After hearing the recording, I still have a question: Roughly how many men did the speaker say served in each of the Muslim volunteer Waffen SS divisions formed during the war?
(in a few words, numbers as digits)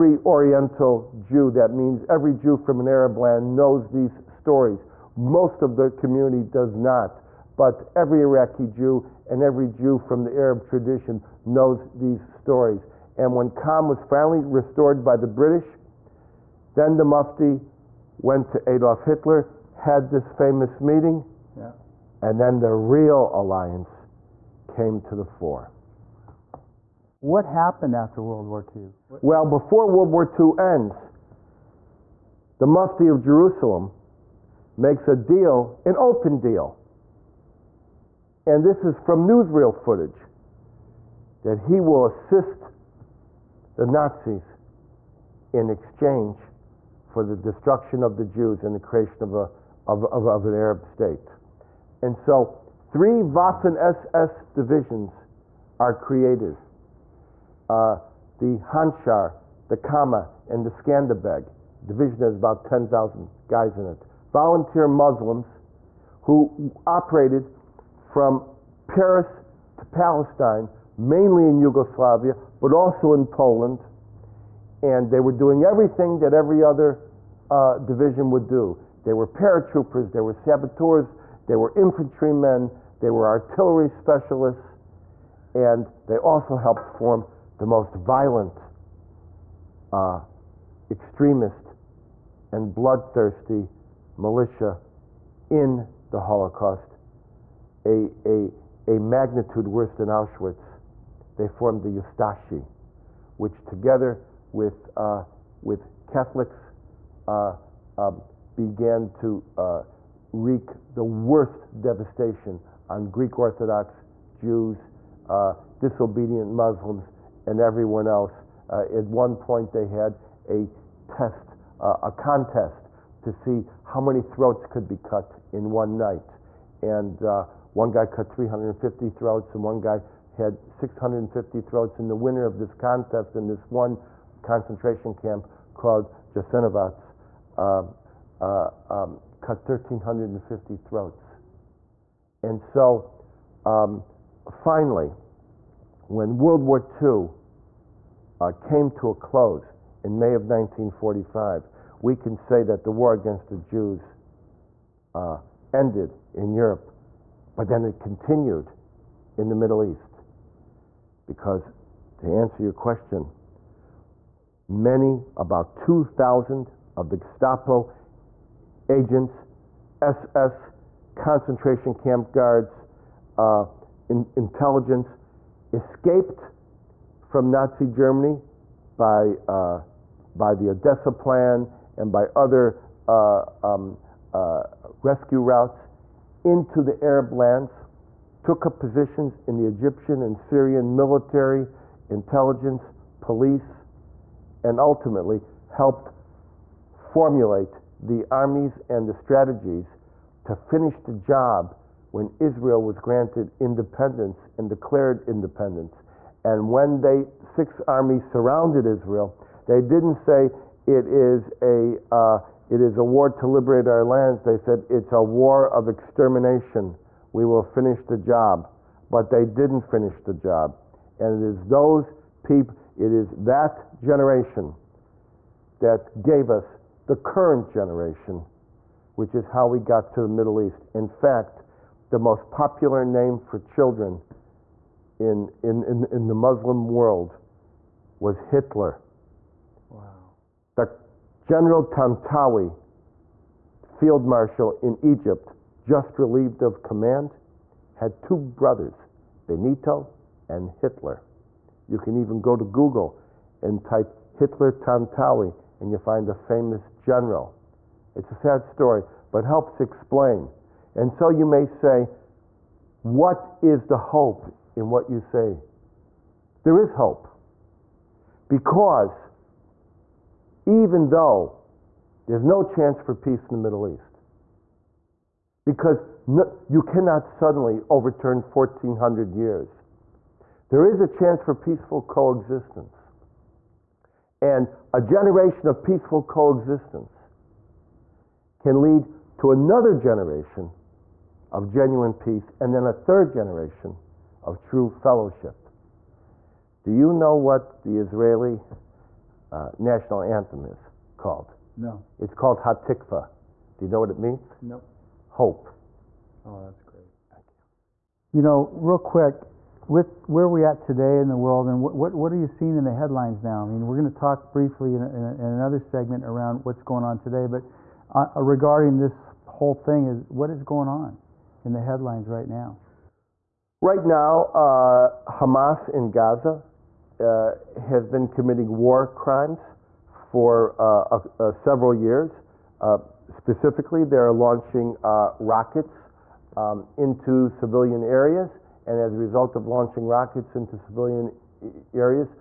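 10,000.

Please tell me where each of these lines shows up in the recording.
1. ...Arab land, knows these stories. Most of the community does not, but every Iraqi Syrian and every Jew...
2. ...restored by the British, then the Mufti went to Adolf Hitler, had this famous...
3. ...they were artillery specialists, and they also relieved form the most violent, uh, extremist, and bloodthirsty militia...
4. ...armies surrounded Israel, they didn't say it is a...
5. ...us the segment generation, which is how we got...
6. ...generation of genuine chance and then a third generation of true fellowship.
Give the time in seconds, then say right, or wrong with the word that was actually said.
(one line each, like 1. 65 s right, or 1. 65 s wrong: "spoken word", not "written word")
1. 2 s wrong: "Jew", not "Syrian"
2. 14 s right
3. 83 s wrong: "helped", not "relieved"
4. 207 s right
5. 226 s wrong: "current", not "segment"
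6. 289 s wrong: "peace", not "chance".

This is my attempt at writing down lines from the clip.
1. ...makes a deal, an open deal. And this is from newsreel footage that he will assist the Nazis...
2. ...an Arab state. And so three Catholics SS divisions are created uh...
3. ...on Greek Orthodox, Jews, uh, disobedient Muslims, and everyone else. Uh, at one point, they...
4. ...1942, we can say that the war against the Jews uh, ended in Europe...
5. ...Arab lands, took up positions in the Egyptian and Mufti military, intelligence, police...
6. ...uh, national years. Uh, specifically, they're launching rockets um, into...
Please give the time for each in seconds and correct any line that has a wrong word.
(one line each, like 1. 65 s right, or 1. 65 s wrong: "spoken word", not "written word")
1. 34 s right
2. 50 s wrong: "Waffen", not "Catholics"
3. 112 s right
4. 150 s wrong: "1945", not "1942"
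5. 187 s wrong: "Syrian", not "Mufti"
6. 330 s wrong: "several", not "national".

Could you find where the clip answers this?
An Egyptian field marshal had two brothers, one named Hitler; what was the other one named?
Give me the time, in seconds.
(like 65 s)
249 s.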